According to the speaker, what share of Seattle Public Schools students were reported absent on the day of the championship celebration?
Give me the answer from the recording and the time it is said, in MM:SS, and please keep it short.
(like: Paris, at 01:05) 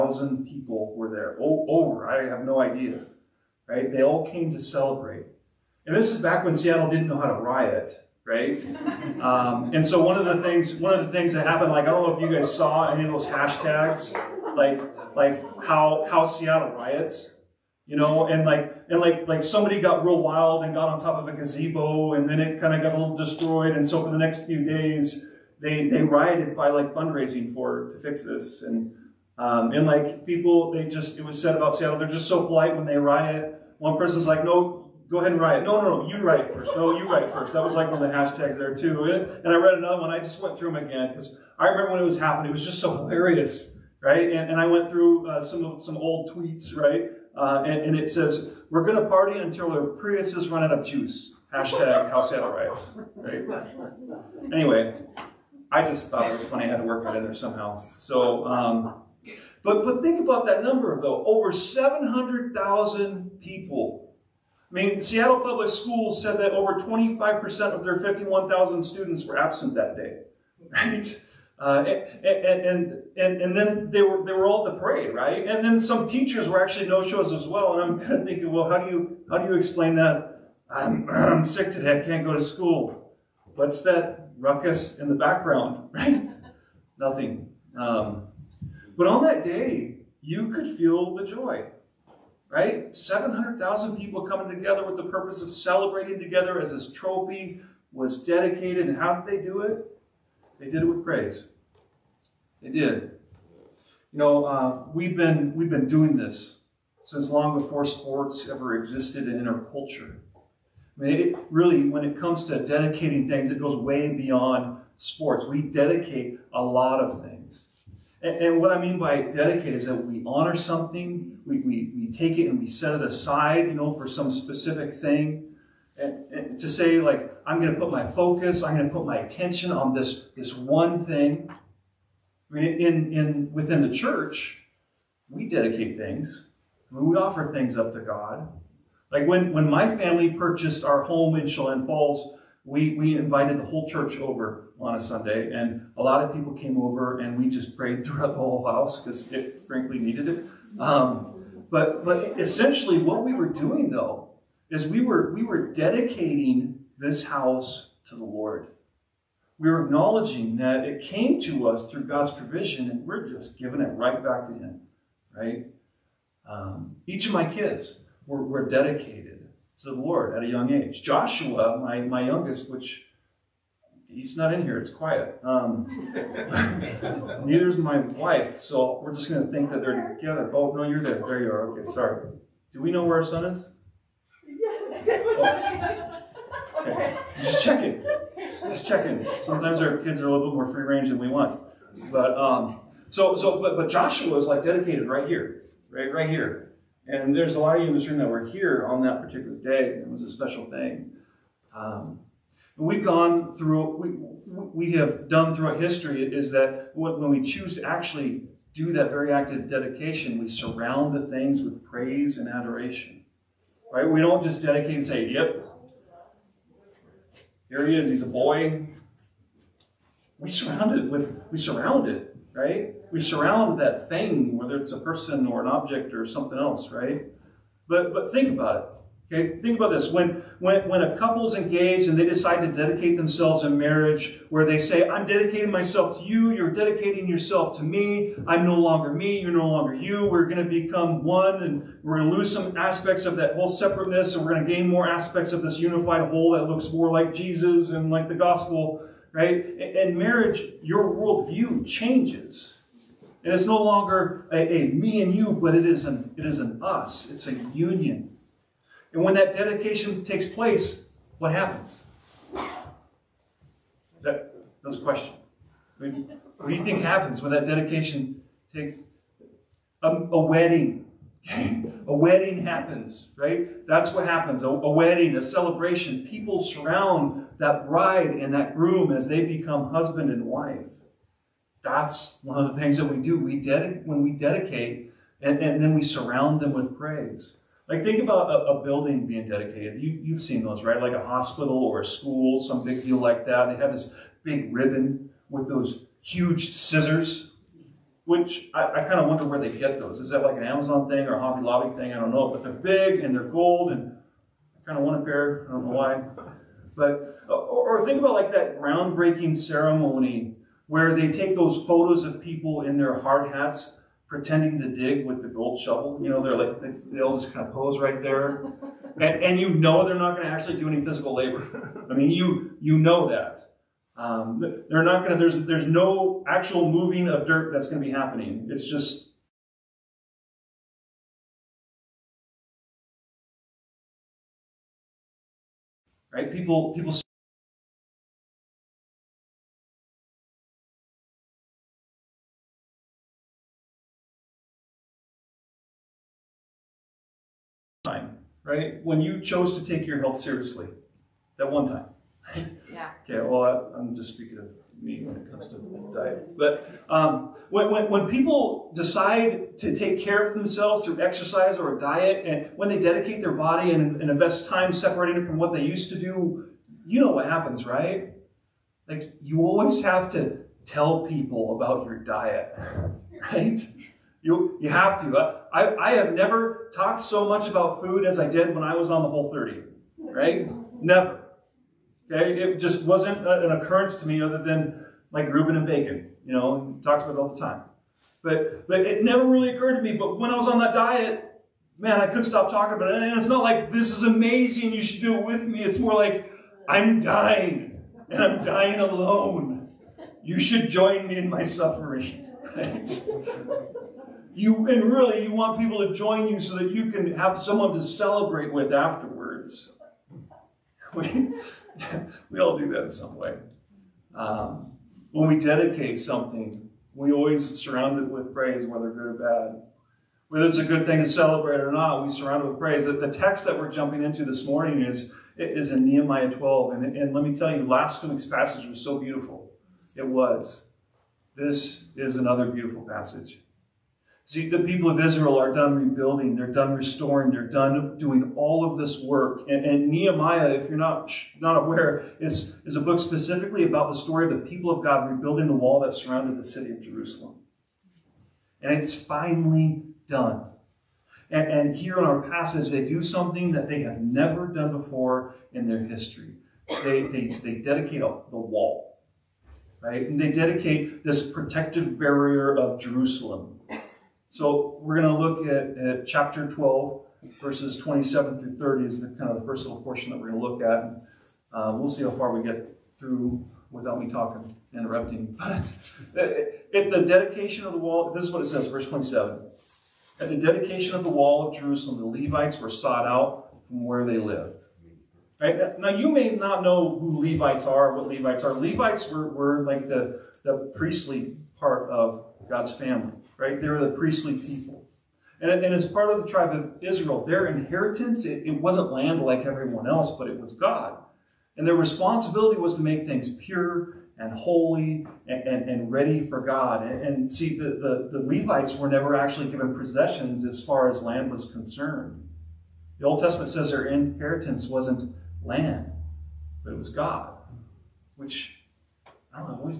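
over 25%, at 01:06.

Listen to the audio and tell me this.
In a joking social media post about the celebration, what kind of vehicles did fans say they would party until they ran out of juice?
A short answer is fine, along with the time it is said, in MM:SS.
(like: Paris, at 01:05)
Priuses, at 00:50.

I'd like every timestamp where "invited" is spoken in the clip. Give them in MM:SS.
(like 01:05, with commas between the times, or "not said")
02:23.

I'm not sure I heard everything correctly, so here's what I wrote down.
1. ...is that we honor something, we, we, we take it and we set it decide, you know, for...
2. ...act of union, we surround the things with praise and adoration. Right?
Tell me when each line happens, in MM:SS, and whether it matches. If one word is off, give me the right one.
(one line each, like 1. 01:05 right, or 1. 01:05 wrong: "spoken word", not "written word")
1. 01:59 wrong: "aside", not "decide"
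2. 03:29 wrong: "dedication", not "union".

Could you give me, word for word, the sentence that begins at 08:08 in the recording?
Levites were, were like the, the priestly part of God's family right?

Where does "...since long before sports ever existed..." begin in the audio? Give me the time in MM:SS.
01:47.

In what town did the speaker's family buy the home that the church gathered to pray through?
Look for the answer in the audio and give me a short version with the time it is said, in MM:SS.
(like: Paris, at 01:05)
Chelan Falls, at 02:21.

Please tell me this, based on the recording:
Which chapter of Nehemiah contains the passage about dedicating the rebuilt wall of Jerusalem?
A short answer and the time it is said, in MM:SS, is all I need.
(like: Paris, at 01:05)
Chapter 12, at 07:06.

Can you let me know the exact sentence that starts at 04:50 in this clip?
Like a hospital or a school, some big deal like that.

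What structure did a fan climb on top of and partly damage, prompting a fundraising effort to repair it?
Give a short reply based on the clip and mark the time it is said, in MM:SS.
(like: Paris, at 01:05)
A gazebo, at 00:21.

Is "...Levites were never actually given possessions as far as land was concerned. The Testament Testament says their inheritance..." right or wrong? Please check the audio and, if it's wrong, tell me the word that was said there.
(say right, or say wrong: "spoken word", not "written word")
wrong: "Old", not "Testament".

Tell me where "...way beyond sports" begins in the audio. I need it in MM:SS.
01:53.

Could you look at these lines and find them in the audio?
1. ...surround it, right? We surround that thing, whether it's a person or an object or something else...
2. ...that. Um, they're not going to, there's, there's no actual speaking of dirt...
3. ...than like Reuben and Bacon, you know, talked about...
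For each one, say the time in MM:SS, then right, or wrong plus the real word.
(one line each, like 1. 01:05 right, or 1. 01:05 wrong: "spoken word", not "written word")
1. 03:41 right
2. 05:23 wrong: "moving", not "speaking"
3. 06:24 right.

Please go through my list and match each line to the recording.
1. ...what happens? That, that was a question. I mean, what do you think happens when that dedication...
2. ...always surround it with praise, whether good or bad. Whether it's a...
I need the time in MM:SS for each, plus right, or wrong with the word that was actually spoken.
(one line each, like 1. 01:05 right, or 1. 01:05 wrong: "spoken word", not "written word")
1. 04:21 right
2. 06:57 right.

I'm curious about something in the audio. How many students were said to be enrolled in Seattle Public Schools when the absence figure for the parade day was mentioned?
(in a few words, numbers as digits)
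51,000.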